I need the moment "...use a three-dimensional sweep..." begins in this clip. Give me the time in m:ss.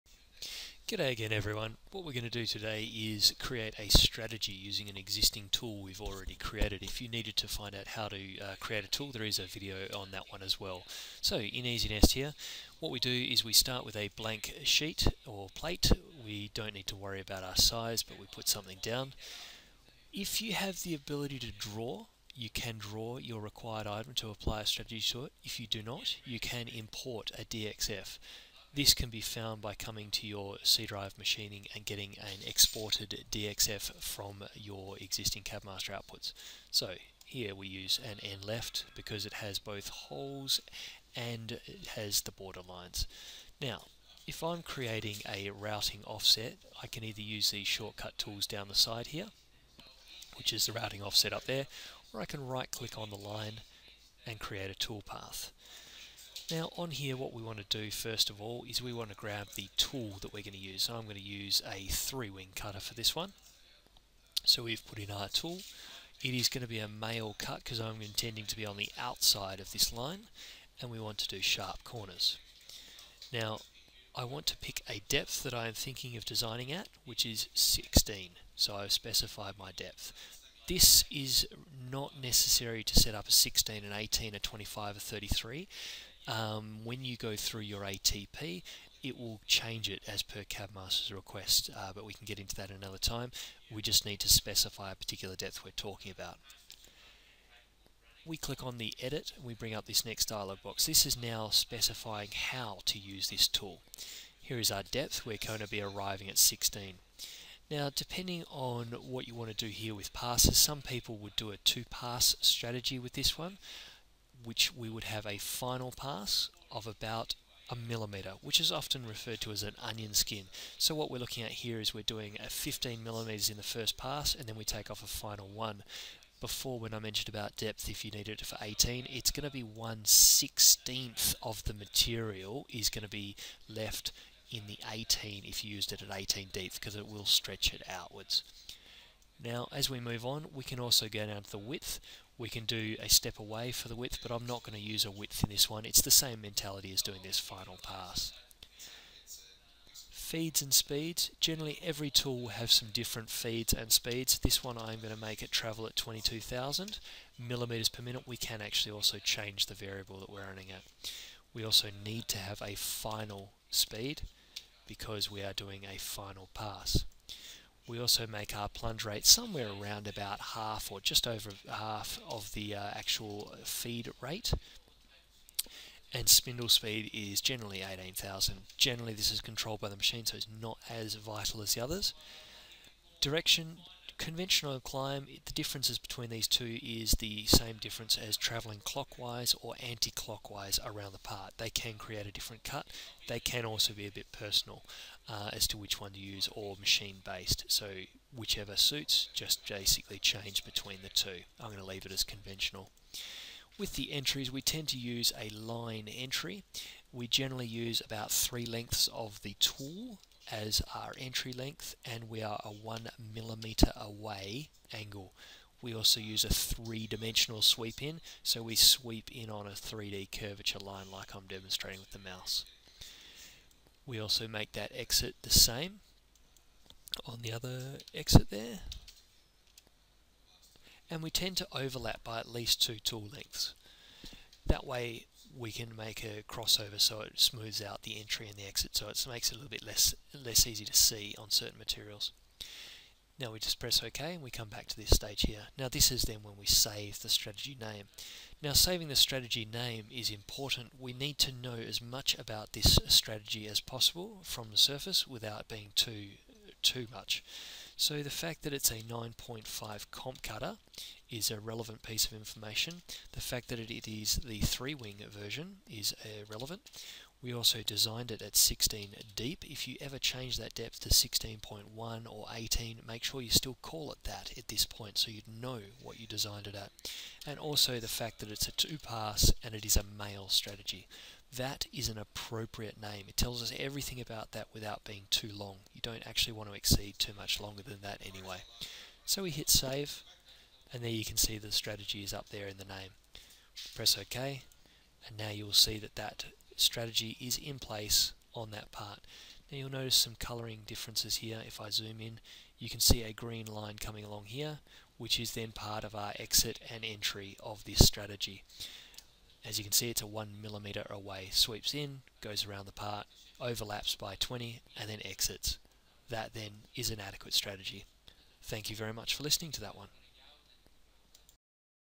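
3:36.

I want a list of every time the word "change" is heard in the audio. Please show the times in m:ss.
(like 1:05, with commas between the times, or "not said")
1:29, 2:39, 3:20, 4:30.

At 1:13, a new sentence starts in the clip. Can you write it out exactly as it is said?
Now I want to pick a depth that I am thinking of designing at which is 16 so I've specified my depth.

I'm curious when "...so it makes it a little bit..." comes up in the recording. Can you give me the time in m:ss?
3:58.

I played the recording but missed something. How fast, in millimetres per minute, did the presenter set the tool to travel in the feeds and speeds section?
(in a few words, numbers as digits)
22,000.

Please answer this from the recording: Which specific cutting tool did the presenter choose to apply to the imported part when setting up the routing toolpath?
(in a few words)
three wing cutter.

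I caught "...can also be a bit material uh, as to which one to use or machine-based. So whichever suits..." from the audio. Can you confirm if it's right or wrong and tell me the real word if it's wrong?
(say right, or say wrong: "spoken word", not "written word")
wrong: "personal", not "material".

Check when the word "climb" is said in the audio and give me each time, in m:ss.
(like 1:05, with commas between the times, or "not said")
3:04.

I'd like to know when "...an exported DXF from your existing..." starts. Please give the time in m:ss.
0:32.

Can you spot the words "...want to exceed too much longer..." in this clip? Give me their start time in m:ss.
4:46.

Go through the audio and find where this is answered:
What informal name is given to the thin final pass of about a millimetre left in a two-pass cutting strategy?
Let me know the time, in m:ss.
1:59.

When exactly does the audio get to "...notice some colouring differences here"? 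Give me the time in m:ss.
4:59.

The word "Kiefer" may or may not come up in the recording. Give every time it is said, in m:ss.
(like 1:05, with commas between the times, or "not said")
not said.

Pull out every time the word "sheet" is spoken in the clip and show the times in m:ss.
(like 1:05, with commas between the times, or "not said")
0:14.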